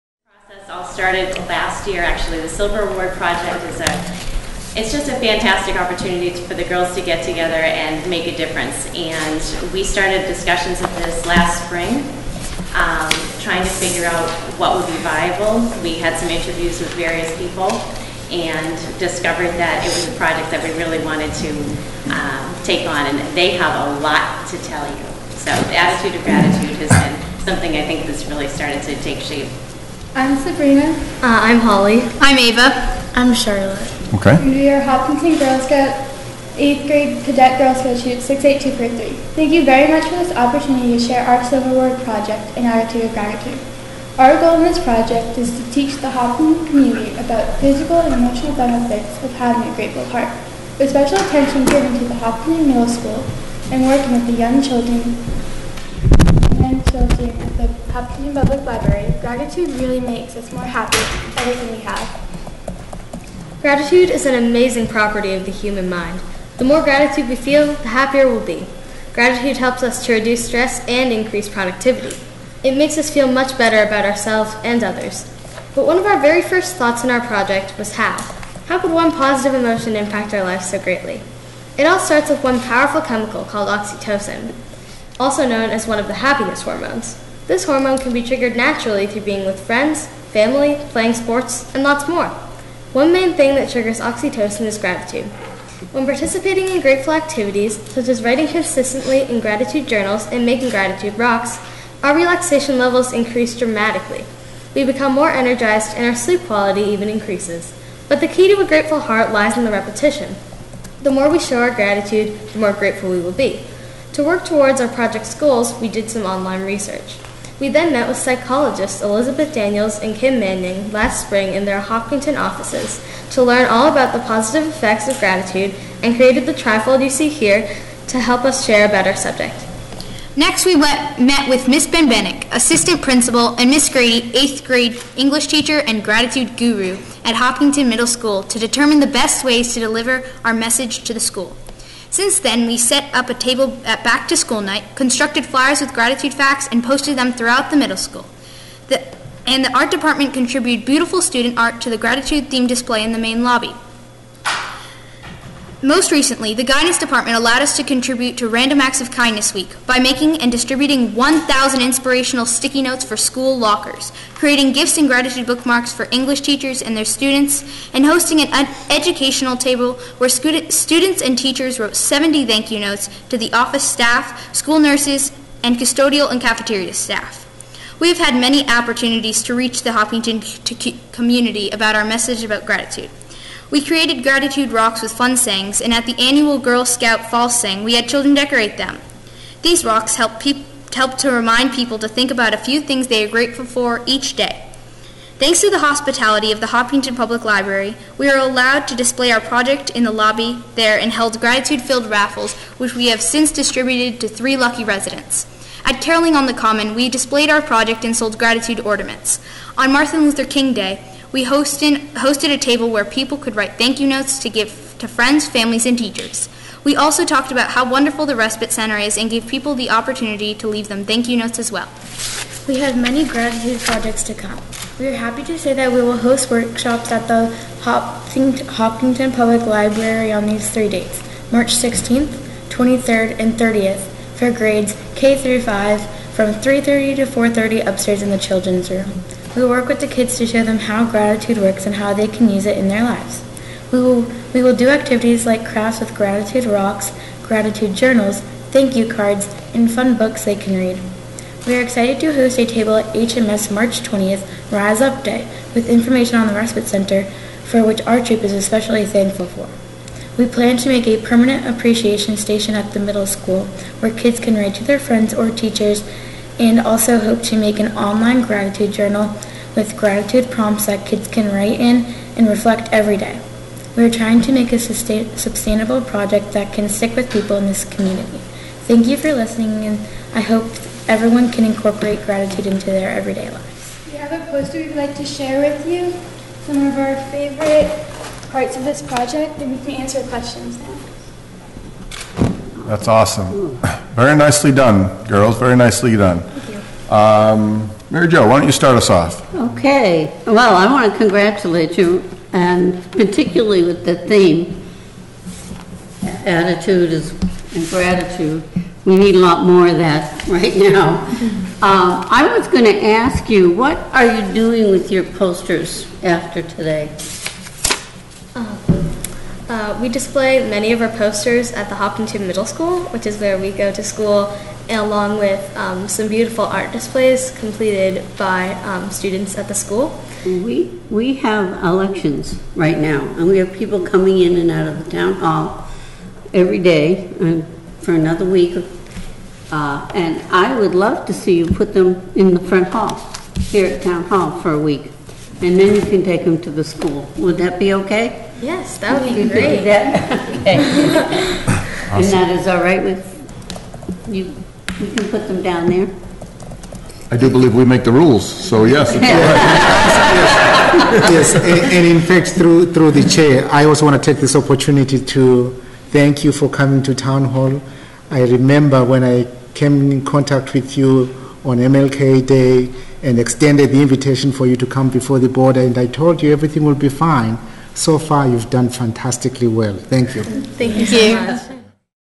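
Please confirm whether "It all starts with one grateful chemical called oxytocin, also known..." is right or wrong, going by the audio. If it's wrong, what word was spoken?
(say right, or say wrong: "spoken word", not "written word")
wrong: "powerful", not "grateful".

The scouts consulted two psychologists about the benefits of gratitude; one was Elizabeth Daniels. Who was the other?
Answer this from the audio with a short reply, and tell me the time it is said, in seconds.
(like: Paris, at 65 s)
Kim Manning, at 120 s.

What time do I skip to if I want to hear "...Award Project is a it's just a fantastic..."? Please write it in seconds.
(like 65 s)
2 s.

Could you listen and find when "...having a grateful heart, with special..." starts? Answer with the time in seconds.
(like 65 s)
49 s.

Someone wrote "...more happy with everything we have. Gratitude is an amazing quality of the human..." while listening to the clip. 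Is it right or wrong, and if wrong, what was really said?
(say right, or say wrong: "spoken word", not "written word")
wrong: "property", not "quality".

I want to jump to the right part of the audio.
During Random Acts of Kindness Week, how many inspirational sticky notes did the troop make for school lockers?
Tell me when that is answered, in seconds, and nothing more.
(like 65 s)
161 s.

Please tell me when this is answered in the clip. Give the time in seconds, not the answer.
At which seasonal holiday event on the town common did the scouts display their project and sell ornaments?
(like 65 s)
206 s.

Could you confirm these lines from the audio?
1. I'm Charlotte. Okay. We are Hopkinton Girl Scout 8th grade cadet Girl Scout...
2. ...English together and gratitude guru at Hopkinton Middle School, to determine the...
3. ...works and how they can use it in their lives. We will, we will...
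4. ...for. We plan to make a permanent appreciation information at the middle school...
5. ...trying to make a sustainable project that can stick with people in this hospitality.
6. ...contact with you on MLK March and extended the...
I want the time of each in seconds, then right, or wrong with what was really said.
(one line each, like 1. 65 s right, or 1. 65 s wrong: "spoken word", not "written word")
1. 33 s right
2. 135 s wrong: "teacher", not "together"
3. 241 s right
4. 259 s wrong: "station", not "information"
5. 274 s wrong: "community", not "hospitality"
6. 370 s wrong: "Day", not "March".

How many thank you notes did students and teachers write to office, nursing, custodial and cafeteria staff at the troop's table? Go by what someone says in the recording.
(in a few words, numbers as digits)
70.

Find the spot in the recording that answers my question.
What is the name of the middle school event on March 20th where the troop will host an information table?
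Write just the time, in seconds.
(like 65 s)
254 s.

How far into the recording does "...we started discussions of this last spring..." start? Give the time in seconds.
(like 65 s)
9 s.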